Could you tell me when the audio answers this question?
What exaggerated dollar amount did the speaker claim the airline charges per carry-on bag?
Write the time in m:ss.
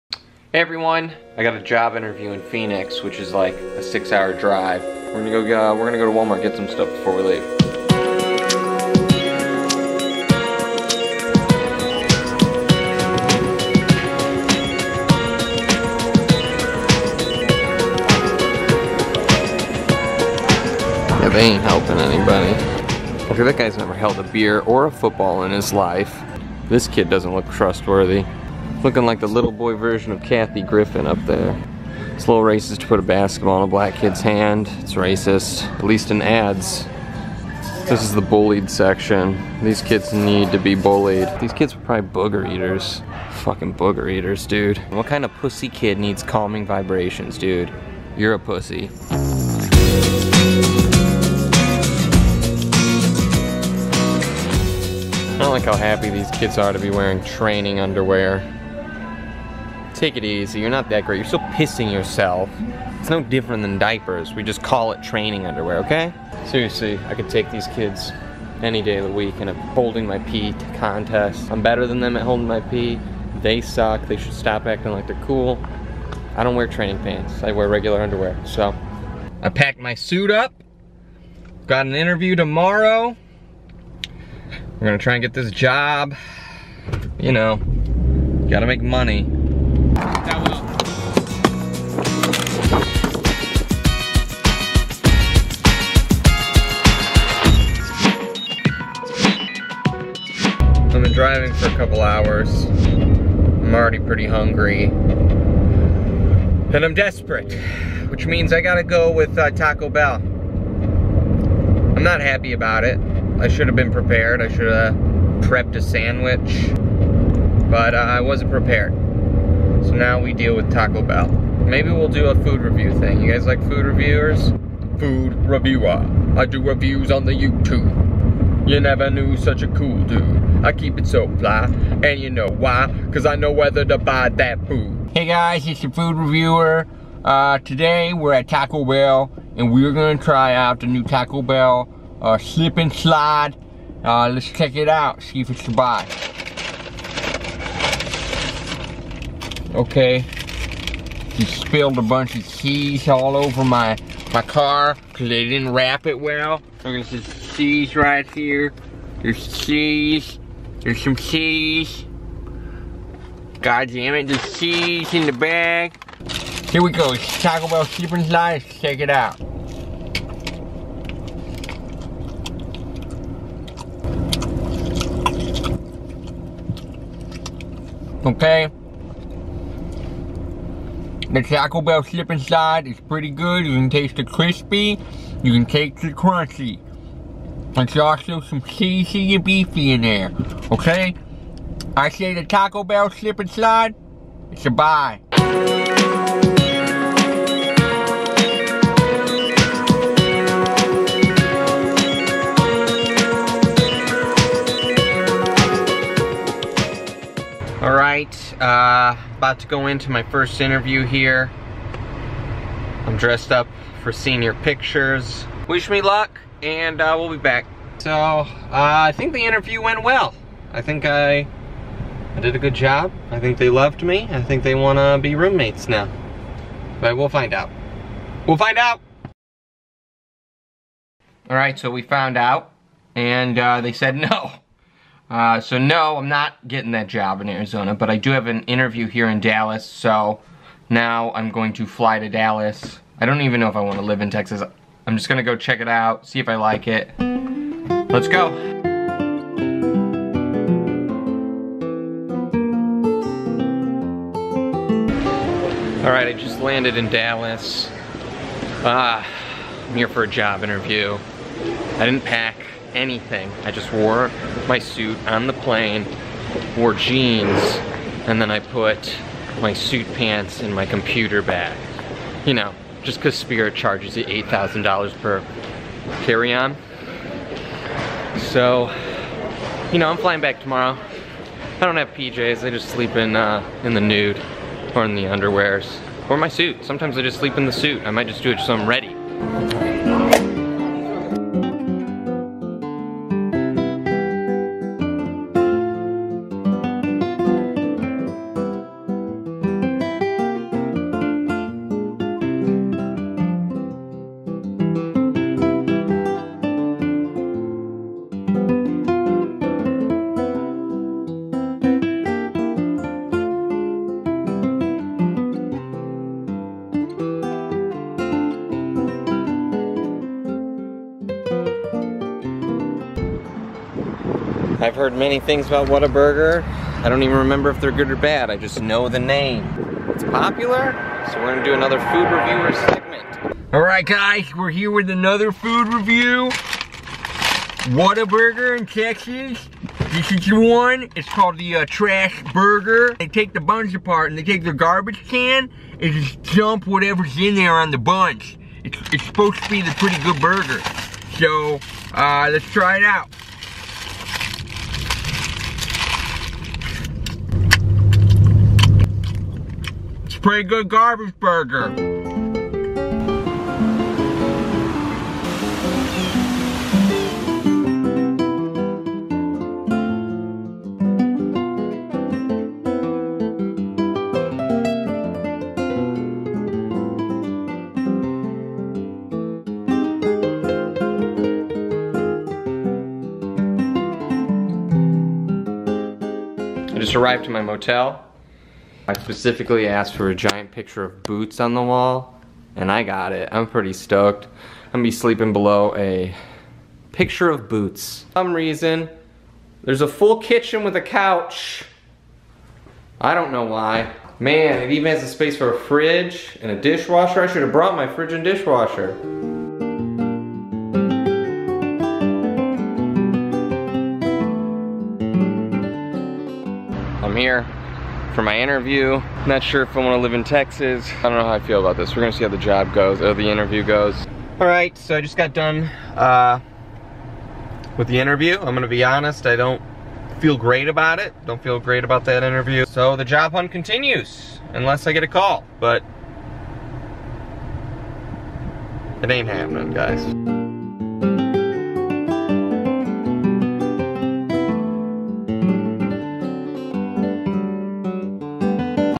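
4:34.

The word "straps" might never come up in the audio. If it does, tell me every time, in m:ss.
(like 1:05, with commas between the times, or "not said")
not said.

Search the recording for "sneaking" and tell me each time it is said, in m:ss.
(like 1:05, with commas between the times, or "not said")
not said.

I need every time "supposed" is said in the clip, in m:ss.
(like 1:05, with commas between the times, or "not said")
5:49.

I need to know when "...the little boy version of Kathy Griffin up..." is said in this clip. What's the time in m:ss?
0:29.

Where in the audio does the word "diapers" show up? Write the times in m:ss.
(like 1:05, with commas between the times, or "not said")
1:03.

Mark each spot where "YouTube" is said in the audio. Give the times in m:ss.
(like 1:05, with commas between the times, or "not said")
2:07.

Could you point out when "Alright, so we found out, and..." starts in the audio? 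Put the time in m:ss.
3:51.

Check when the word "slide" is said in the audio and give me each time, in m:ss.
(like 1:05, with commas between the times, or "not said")
2:22, 3:02, 3:13.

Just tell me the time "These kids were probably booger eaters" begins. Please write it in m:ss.
0:41.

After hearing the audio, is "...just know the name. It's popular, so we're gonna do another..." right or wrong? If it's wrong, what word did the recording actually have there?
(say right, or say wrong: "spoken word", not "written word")
right.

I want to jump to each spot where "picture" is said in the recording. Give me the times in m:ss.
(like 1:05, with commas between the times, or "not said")
3:34, 6:30, 6:37.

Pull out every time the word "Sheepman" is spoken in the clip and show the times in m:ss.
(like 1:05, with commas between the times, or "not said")
2:47.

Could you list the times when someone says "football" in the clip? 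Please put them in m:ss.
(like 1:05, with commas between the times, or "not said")
0:24.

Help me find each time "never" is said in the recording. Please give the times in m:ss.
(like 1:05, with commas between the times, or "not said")
0:23, 2:08.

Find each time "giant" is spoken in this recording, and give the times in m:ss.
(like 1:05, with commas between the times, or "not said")
6:30.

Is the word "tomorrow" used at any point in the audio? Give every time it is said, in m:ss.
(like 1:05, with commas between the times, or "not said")
1:22, 4:40.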